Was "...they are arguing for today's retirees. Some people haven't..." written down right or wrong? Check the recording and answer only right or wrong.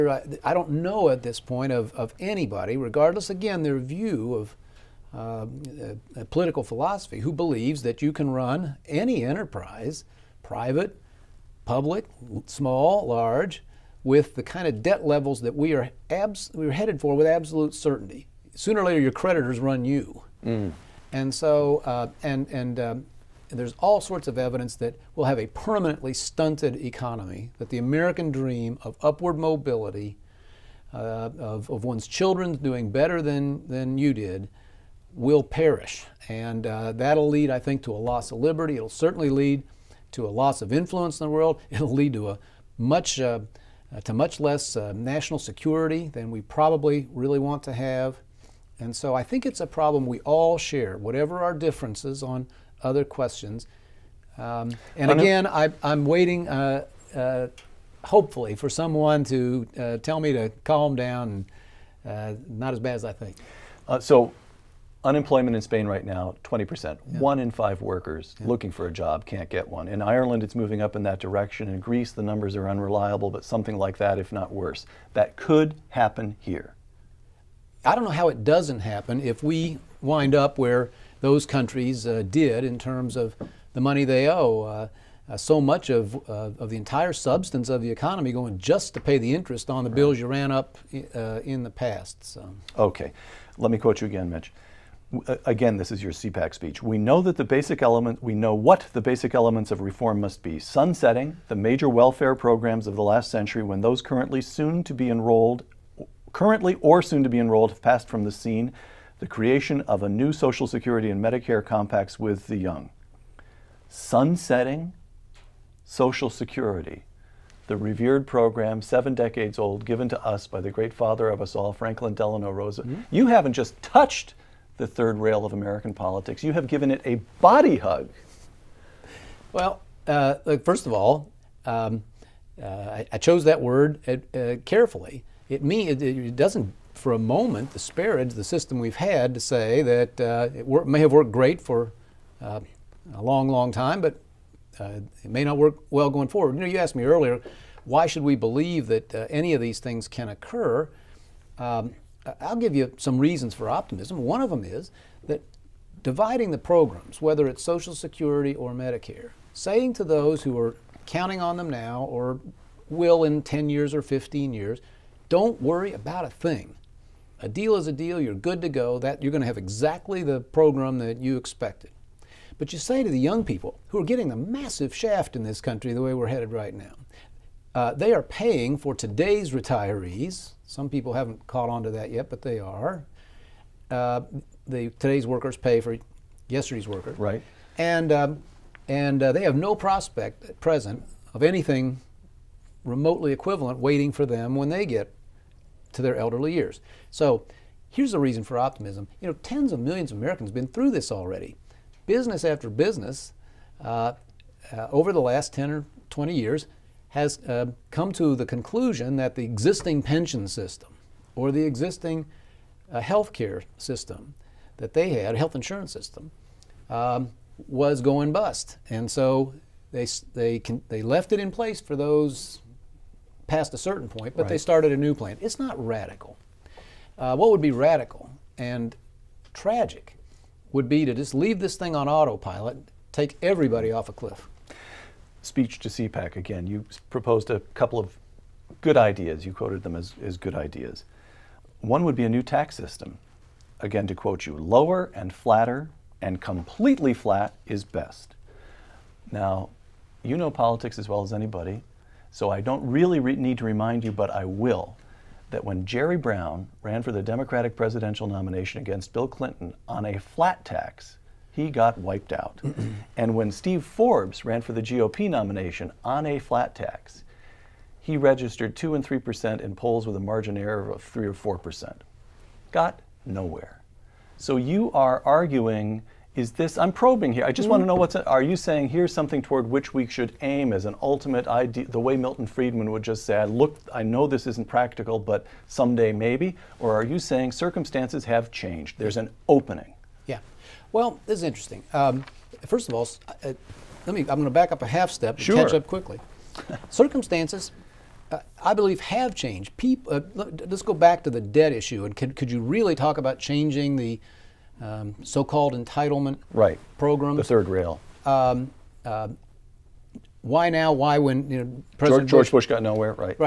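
wrong.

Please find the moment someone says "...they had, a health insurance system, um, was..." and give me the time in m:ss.
3:34.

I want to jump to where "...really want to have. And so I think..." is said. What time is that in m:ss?
0:47.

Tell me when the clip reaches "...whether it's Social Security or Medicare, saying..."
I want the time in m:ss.
2:37.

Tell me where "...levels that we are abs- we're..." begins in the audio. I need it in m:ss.
0:15.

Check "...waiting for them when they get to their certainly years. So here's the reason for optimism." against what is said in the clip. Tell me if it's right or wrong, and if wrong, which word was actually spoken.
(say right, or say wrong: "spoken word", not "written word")
wrong: "elderly", not "certainly".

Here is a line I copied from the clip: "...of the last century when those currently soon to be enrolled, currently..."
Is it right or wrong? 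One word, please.
right.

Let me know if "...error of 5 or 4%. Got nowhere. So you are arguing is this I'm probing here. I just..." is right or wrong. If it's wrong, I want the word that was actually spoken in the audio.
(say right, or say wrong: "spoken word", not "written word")
wrong: "3", not "5".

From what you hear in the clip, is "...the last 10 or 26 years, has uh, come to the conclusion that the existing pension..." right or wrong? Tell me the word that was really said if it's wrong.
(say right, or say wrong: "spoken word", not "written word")
wrong: "20", not "26".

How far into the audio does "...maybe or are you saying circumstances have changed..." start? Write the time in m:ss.
4:46.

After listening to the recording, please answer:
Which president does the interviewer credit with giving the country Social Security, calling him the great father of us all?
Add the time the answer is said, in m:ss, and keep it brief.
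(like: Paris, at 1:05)
Franklin Delano Roosevelt, at 2:01.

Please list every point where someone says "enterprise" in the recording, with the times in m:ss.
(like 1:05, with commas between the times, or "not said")
0:09.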